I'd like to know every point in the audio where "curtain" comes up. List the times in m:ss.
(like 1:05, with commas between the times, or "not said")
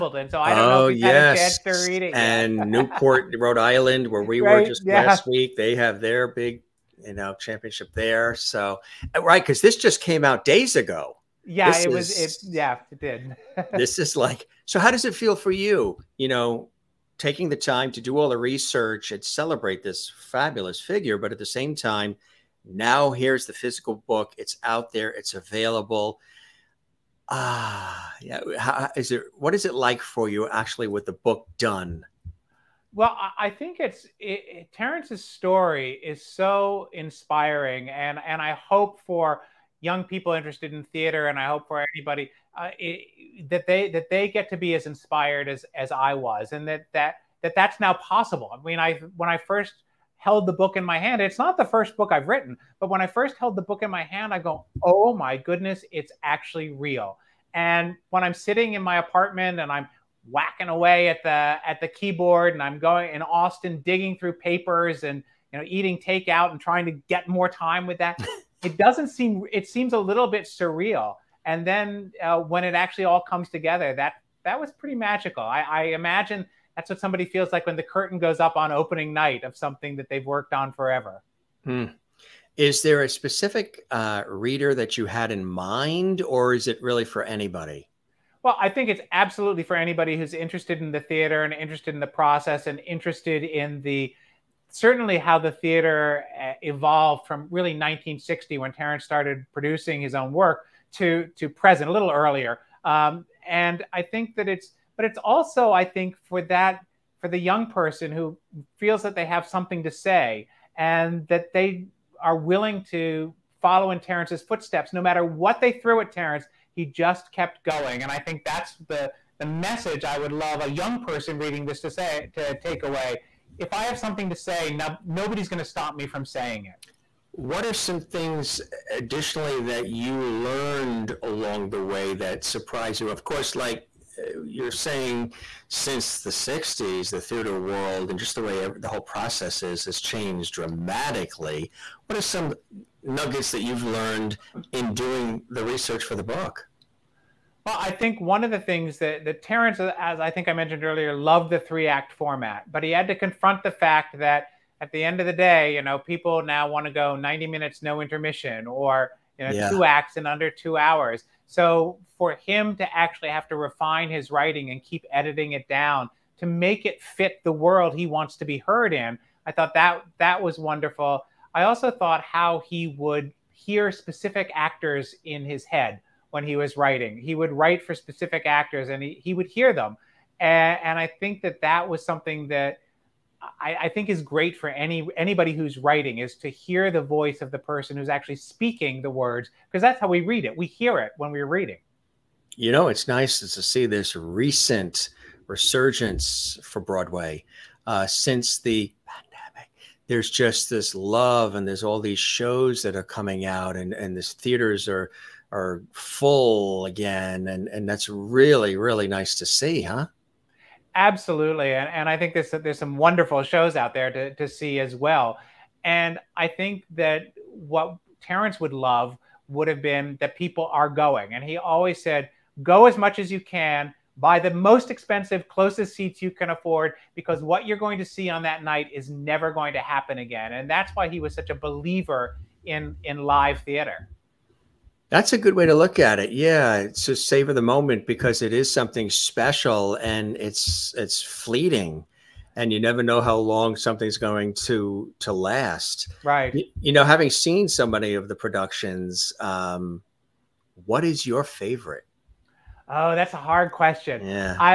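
1:17.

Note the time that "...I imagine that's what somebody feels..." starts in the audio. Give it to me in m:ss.
1:15.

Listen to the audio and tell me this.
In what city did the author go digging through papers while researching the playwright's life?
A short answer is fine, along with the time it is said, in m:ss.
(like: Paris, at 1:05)
Austin, at 1:03.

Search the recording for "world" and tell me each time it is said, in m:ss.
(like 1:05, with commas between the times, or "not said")
2:17, 2:47.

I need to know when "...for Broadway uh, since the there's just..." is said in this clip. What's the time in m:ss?
3:16.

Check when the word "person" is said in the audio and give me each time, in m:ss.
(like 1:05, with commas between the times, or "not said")
1:47, 2:01, 3:07.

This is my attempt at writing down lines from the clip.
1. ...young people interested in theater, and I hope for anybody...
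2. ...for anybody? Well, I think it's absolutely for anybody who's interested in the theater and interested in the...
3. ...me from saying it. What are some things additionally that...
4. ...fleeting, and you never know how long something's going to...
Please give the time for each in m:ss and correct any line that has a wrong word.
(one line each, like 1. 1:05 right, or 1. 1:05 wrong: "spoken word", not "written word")
1. 0:39 right
2. 1:27 right
3. 2:05 right
4. 4:01 right.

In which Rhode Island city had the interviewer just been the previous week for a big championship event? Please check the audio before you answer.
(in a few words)
Newport.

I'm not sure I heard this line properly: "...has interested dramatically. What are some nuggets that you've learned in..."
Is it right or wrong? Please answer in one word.
wrong.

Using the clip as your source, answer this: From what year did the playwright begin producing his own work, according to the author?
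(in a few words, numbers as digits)
1960.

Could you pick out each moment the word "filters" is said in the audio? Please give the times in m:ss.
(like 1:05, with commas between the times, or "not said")
not said.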